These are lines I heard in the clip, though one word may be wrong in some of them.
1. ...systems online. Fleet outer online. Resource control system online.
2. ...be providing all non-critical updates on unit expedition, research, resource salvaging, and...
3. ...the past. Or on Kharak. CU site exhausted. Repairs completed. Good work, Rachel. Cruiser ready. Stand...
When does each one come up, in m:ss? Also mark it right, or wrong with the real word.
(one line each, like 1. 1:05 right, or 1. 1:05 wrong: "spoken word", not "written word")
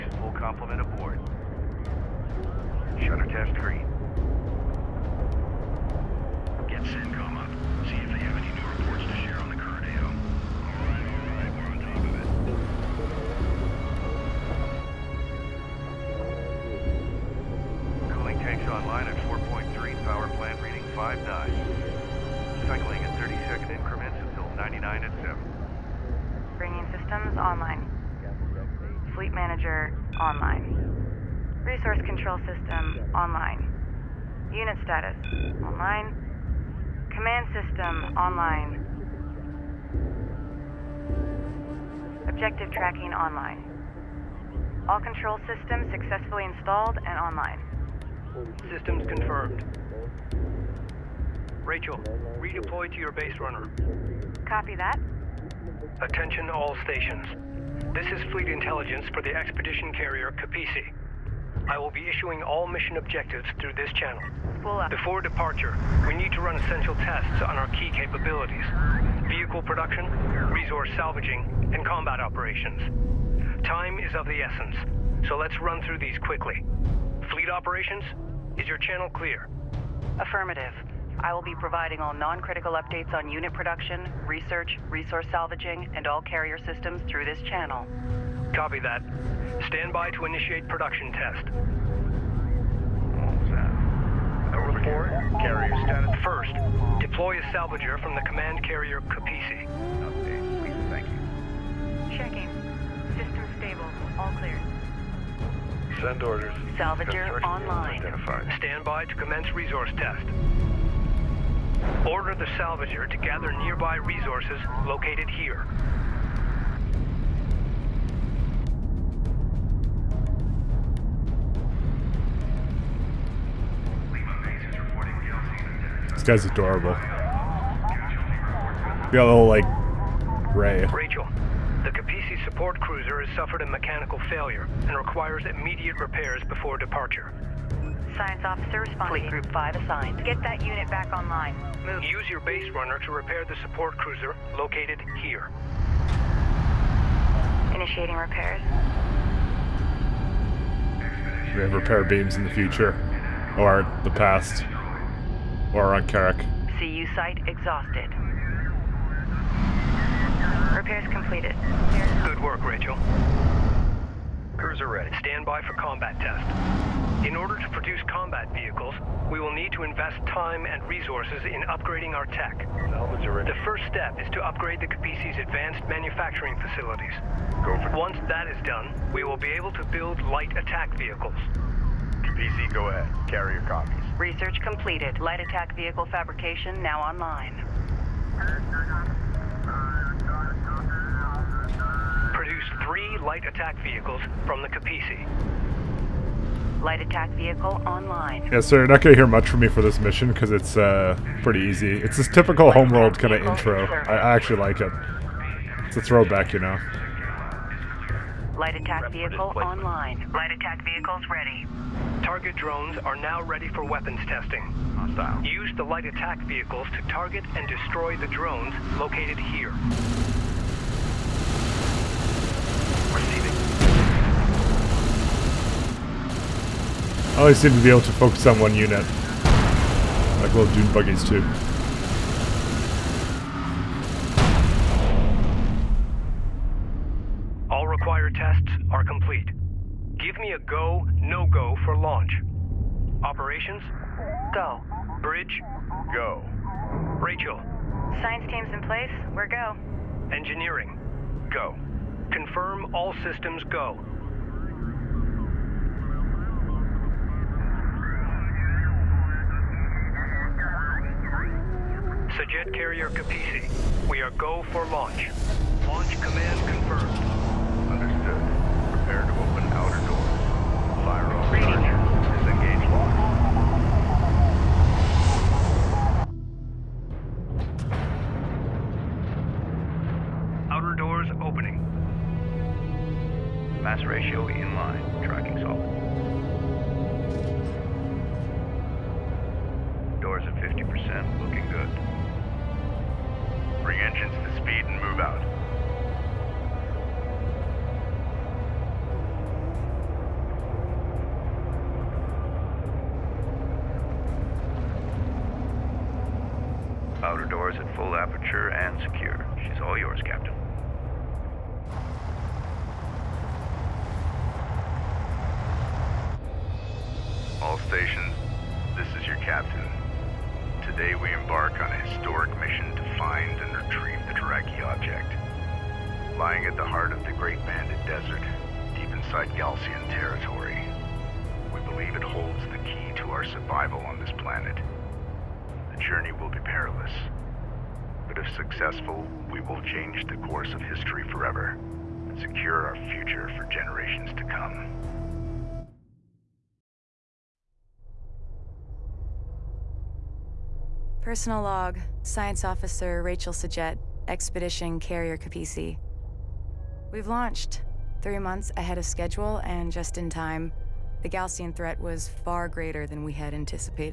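1. 0:27 wrong: "manager", not "outer"
2. 1:21 wrong: "production", not "expedition"
3. 2:34 right.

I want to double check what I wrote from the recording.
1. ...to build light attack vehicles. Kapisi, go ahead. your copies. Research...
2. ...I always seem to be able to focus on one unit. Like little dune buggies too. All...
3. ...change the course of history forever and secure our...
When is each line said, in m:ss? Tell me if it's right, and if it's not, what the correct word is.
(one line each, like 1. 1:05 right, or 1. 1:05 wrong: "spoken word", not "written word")
1. 2:59 right
2. 3:47 right
3. 5:39 right.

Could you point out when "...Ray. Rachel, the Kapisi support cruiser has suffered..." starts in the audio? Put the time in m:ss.
2:10.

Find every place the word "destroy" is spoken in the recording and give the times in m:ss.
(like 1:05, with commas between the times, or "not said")
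3:37.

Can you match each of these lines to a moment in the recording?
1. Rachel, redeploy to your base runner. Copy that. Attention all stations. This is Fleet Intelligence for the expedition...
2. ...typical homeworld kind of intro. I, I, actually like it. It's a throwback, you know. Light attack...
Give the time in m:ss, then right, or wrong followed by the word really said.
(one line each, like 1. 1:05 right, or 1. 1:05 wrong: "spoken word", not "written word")
1. 0:51 right
2. 3:22 right.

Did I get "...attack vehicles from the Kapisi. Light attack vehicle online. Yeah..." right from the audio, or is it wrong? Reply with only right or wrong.
right.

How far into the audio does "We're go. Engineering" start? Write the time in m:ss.
4:09.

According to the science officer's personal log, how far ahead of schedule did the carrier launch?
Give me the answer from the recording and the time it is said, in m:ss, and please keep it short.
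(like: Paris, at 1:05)
3 months, at 5:58.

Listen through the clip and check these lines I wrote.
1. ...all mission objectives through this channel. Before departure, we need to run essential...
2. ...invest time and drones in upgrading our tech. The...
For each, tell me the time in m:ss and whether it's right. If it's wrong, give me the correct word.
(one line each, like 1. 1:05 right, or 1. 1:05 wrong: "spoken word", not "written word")
1. 1:02 right
2. 2:49 wrong: "resources", not "drones".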